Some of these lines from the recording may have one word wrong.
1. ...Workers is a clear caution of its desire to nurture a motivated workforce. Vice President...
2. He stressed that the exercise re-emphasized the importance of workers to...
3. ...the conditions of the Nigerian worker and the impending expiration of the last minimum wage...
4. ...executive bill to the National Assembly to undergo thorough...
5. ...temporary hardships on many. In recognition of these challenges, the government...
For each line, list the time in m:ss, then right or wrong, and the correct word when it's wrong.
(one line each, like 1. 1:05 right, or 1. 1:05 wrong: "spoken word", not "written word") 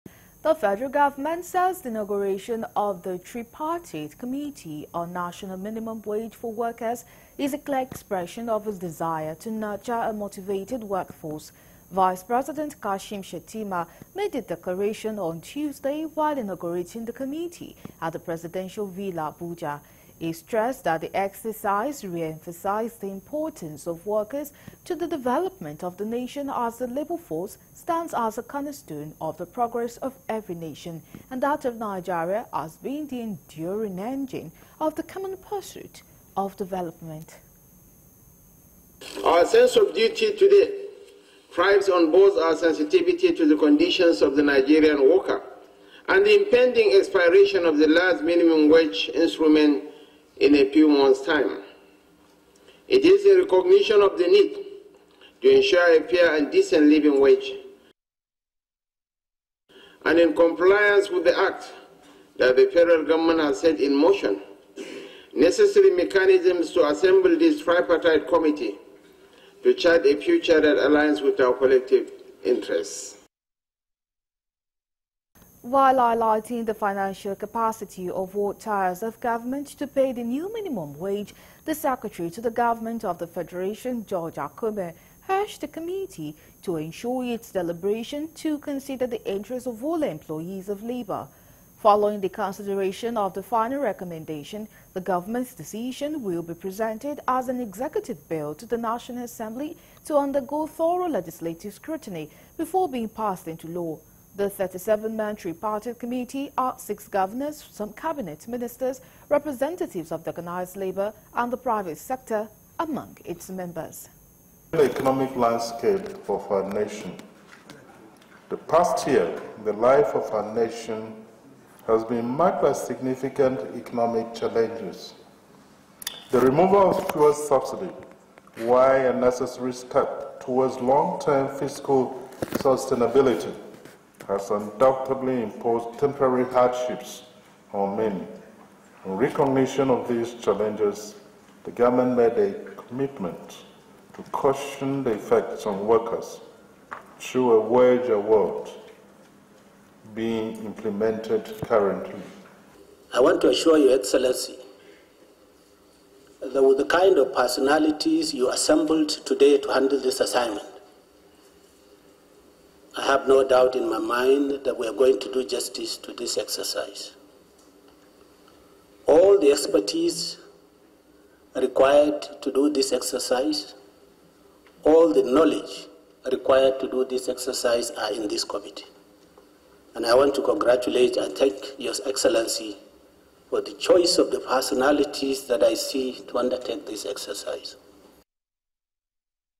1. 0:06 wrong: "expression", not "caution"
2. 0:20 right
3. 0:43 right
4. 1:37 right
5. 2:15 right.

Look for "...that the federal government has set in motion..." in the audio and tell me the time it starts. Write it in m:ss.
1:02.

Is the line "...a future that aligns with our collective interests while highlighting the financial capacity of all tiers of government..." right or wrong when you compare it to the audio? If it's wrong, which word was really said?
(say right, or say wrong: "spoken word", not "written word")
right.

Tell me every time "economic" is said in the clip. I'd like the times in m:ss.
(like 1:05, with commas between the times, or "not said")
1:54, 2:03.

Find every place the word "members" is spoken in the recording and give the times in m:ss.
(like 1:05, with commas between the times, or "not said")
1:53.